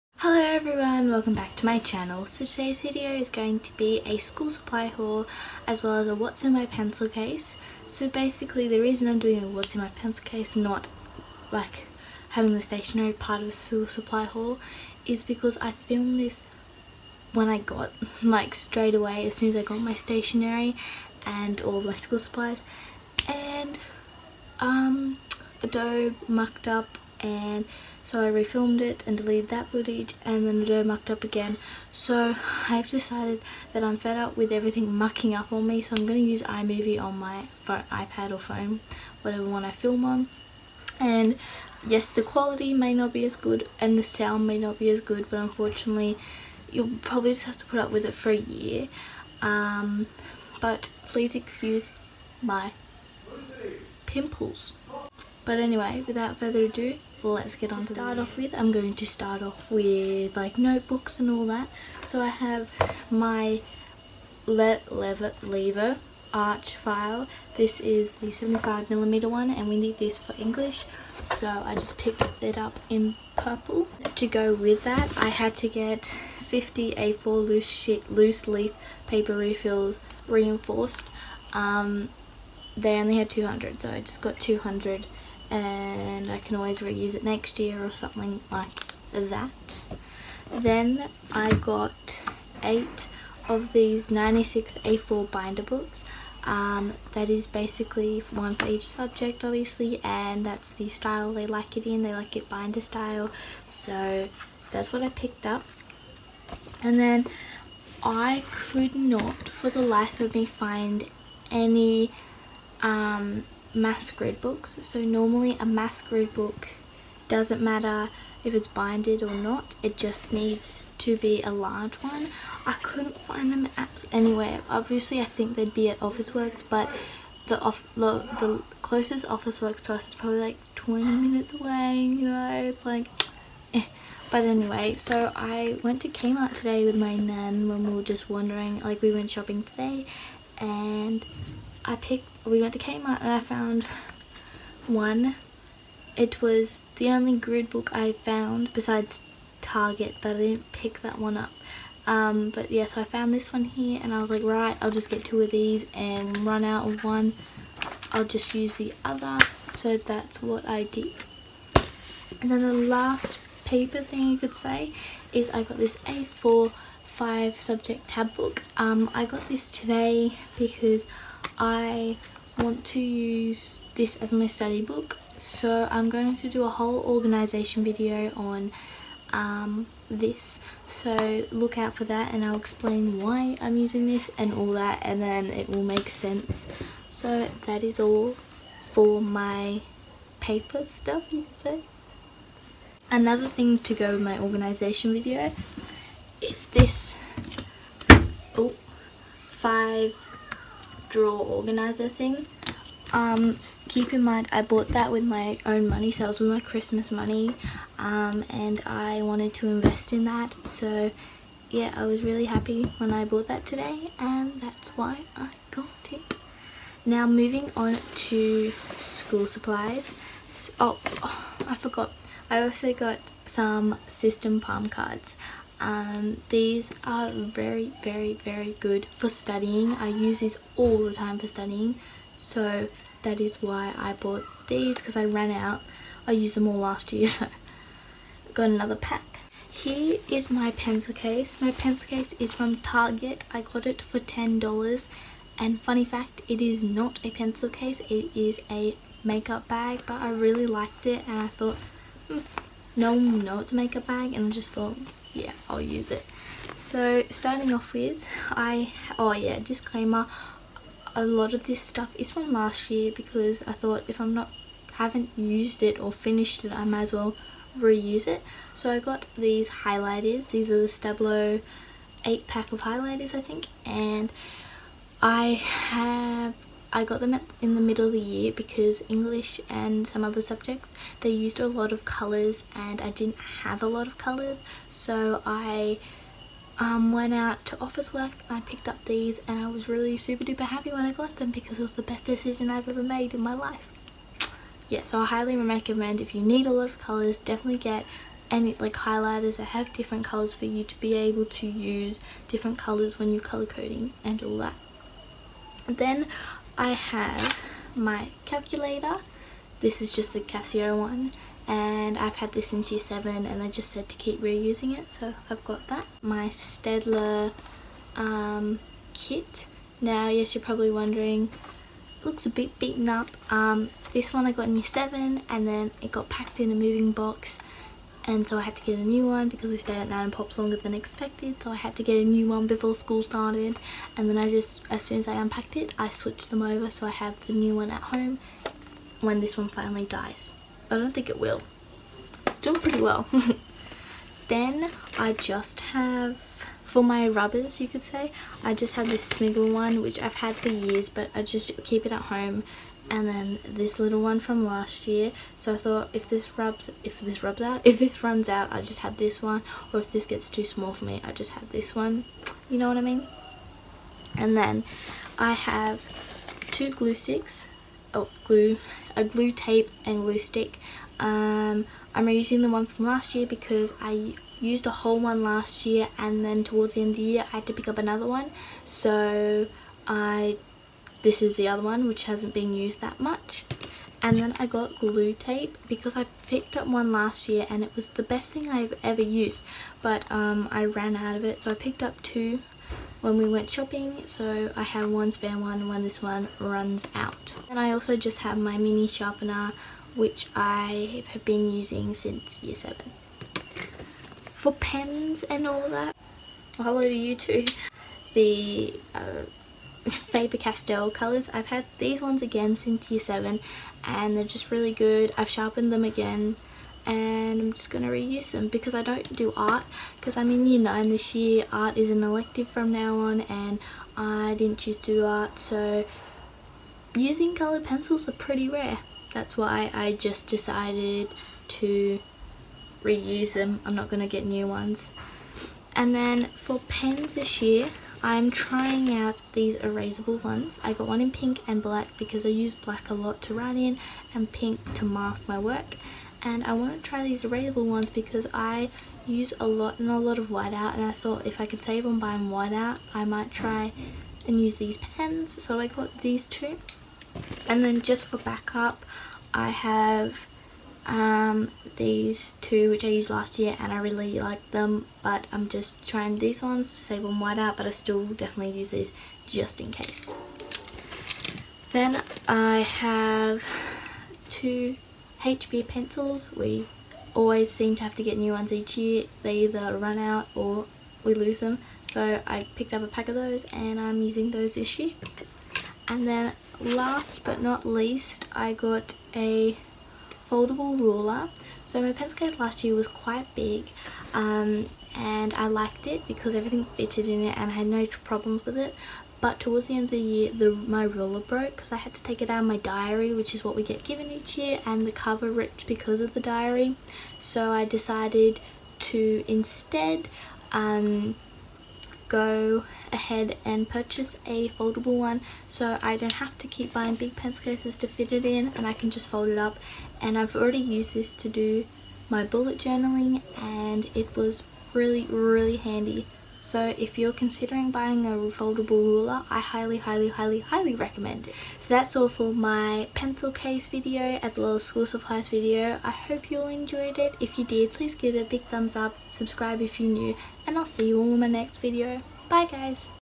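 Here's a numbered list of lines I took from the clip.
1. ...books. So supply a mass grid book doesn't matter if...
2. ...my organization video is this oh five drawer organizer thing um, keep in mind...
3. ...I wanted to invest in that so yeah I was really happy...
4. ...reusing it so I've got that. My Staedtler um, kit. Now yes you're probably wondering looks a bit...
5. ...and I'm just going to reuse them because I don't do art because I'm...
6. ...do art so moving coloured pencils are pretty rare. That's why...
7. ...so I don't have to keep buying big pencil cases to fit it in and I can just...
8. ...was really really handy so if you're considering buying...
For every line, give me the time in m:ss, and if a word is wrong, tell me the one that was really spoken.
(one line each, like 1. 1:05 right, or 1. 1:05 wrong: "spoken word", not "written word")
1. 1:54 wrong: "normally", not "supply"
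2. 3:14 right
3. 3:28 right
4. 5:14 right
5. 6:57 right
6. 7:05 wrong: "using", not "moving"
7. 8:35 right
8. 8:44 right.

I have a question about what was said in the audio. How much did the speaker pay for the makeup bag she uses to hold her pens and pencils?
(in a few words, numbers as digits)
$10.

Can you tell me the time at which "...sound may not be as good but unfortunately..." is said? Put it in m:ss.
0:44.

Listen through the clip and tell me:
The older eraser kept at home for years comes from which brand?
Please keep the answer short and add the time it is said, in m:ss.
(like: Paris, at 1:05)
Smiggle, at 5:49.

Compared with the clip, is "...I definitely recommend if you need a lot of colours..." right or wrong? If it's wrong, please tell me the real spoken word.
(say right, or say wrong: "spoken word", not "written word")
wrong: "highly", not "definitely".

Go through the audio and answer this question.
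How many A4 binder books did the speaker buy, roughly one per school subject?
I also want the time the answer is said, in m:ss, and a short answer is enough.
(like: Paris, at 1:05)
8, at 1:32.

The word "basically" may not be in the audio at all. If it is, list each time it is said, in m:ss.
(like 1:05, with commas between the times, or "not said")
0:08, 1:37.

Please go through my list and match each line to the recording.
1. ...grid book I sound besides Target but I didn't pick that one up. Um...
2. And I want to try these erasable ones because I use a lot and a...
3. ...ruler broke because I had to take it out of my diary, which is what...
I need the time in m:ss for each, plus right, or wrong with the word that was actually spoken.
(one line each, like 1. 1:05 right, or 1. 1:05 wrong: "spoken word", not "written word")
1. 2:27 wrong: "found", not "sound"
2. 7:26 right
3. 8:21 right.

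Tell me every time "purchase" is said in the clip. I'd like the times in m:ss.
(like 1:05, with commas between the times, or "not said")
8:33.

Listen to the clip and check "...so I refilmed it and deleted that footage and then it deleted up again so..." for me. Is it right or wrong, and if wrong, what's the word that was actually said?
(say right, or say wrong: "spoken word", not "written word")
wrong: "mucked", not "deleted".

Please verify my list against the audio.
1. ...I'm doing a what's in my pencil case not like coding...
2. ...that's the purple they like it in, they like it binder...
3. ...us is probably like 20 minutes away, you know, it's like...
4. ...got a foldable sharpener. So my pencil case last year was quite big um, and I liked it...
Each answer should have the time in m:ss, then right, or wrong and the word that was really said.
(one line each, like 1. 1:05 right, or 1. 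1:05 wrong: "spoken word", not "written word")
1. 0:09 wrong: "having", not "coding"
2. 1:40 wrong: "style", not "purple"
3. 2:09 right
4. 8:08 wrong: "ruler", not "sharpener".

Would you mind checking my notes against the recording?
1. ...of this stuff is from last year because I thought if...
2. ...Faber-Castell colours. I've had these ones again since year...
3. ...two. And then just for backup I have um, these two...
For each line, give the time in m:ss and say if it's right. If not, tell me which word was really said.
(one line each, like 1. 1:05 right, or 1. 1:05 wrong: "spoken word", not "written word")
1. 4:21 right
2. 6:50 right
3. 7:36 right.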